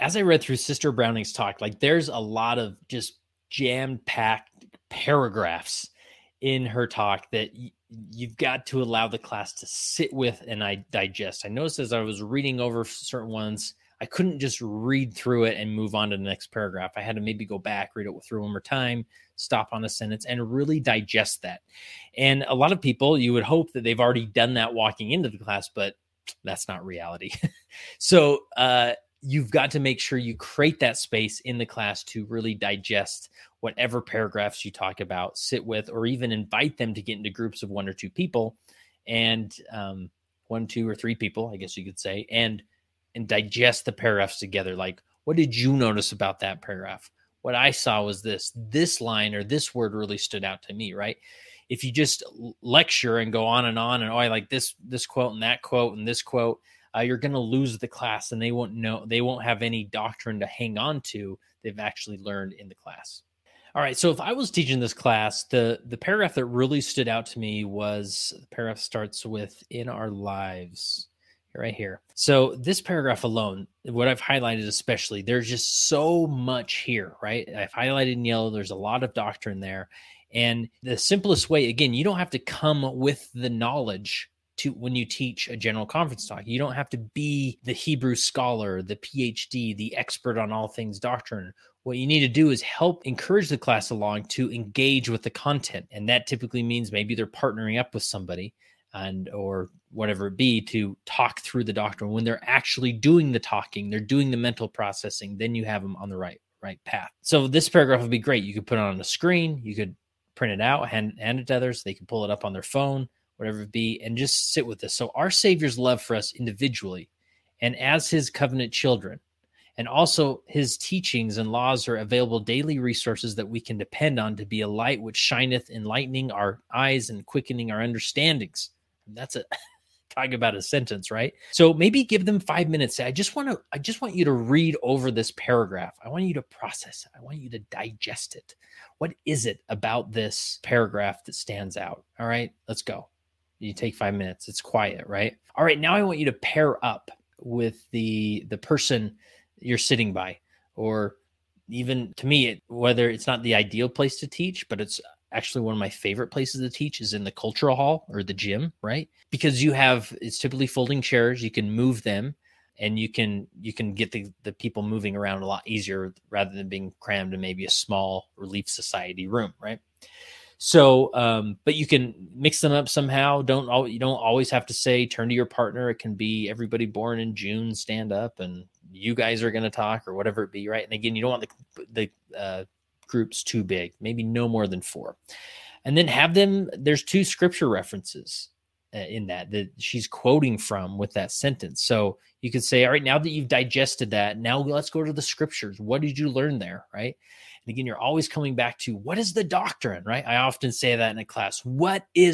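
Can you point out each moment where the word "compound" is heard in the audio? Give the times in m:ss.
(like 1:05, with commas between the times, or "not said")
not said.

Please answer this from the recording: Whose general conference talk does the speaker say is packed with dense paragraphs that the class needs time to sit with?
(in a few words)
Sister Browning.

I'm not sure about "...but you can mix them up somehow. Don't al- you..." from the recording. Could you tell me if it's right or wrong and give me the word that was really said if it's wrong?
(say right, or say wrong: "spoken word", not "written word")
right.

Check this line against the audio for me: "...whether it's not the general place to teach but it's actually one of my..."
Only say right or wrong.
wrong.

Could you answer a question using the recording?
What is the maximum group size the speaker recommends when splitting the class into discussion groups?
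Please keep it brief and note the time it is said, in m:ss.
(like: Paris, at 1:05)
4, at 3:04.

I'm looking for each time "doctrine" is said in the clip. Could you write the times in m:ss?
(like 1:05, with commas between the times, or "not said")
0:59, 1:19, 1:30, 1:41, 3:19.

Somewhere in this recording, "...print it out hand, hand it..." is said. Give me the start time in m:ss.
1:50.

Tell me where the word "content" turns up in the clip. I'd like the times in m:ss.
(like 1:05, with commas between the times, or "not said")
1:35.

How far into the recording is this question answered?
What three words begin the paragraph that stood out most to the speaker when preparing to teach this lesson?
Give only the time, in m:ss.
1:09.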